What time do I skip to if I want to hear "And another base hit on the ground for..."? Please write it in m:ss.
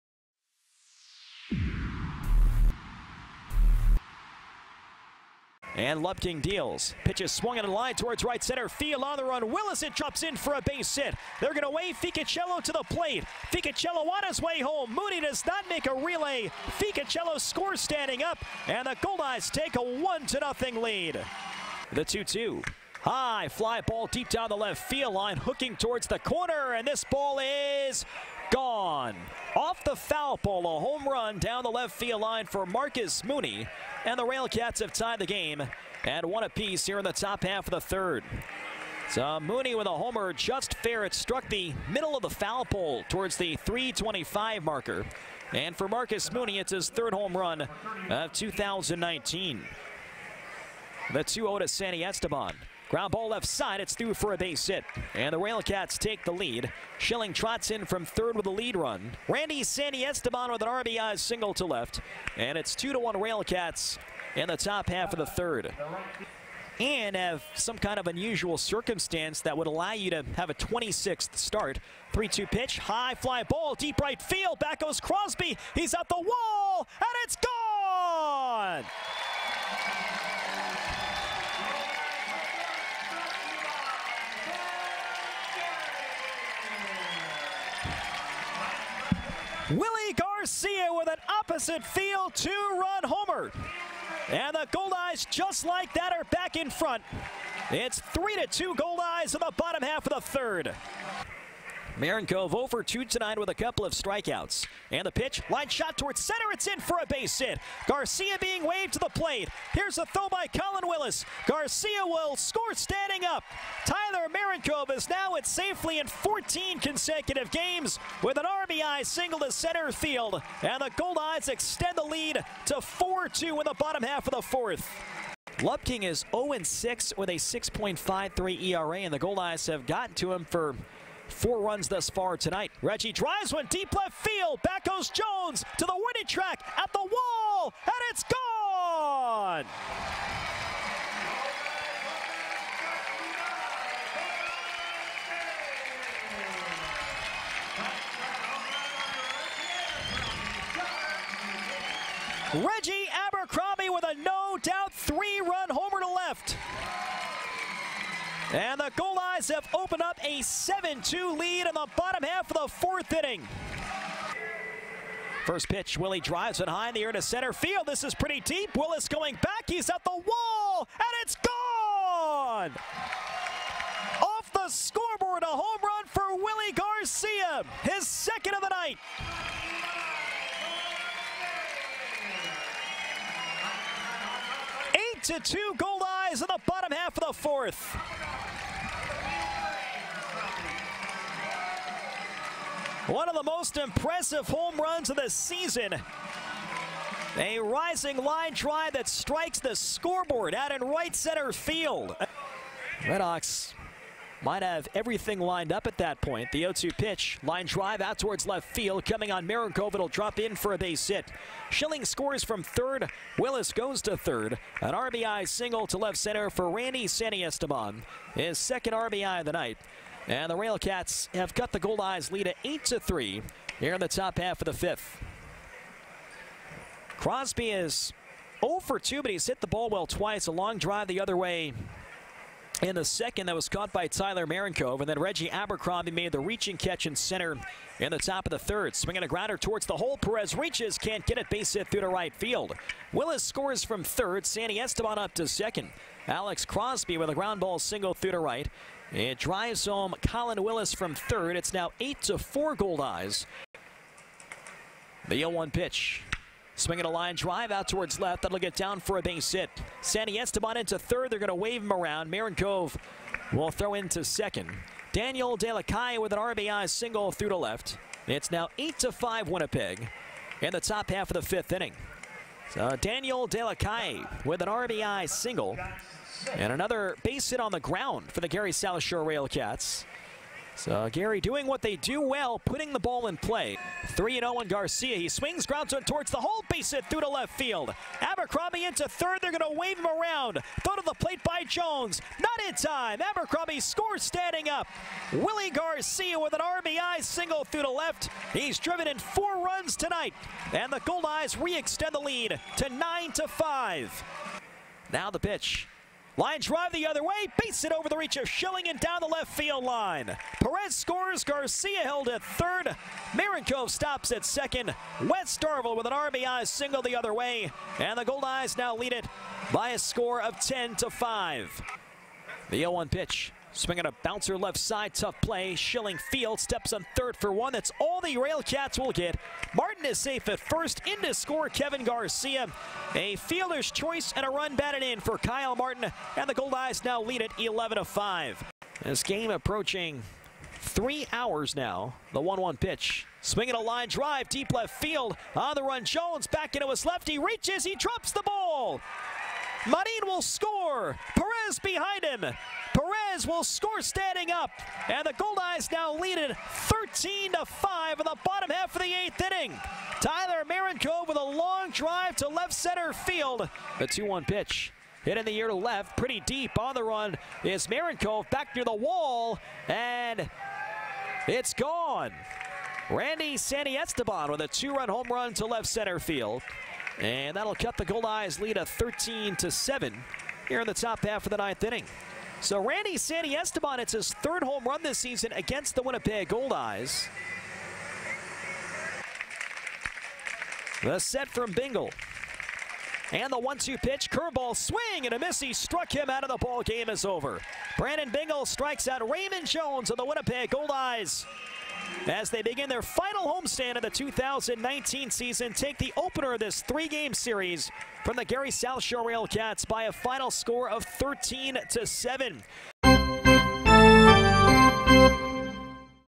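4:36.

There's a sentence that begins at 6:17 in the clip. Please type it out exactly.
And that'll cut the Goldeyes lead to 13 to 7 here in the top half of the ninth inning.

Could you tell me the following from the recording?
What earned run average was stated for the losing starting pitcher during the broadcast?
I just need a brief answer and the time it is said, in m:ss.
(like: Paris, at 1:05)
6.53, at 2:07.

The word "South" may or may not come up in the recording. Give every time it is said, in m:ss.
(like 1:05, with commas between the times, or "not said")
4:38, 6:48.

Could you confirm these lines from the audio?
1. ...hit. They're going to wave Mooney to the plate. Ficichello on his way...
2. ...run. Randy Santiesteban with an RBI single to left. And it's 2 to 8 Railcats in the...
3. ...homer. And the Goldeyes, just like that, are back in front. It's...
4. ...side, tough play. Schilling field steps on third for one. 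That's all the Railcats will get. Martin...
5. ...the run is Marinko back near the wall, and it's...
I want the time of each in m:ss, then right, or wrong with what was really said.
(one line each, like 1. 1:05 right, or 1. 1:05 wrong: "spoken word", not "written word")
1. 0:10 wrong: "Ficichello", not "Mooney"
2. 0:58 wrong: "1", not "8"
3. 1:33 right
4. 5:24 right
5. 6:06 right.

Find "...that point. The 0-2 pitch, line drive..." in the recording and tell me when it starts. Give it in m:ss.
3:25.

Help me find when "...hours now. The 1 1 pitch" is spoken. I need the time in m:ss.
5:41.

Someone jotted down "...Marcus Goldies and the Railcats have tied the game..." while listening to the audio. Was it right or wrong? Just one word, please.
wrong.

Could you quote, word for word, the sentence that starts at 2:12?
Reggie drives one deep left field.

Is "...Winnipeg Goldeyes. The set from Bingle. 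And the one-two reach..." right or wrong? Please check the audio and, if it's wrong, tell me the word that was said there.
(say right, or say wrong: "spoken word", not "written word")
wrong: "pitch", not "reach".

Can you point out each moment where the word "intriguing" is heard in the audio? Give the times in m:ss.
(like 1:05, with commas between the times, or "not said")
not said.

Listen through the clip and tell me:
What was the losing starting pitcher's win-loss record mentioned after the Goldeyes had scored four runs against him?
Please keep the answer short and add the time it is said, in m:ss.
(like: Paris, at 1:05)
0-6, at 2:06.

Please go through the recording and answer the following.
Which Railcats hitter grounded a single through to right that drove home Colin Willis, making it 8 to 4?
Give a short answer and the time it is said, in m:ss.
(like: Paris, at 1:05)
Alex Crosby, at 4:06.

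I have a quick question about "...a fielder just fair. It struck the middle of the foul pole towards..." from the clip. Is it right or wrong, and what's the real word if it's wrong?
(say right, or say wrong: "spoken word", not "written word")
wrong: "homer", not "fielder".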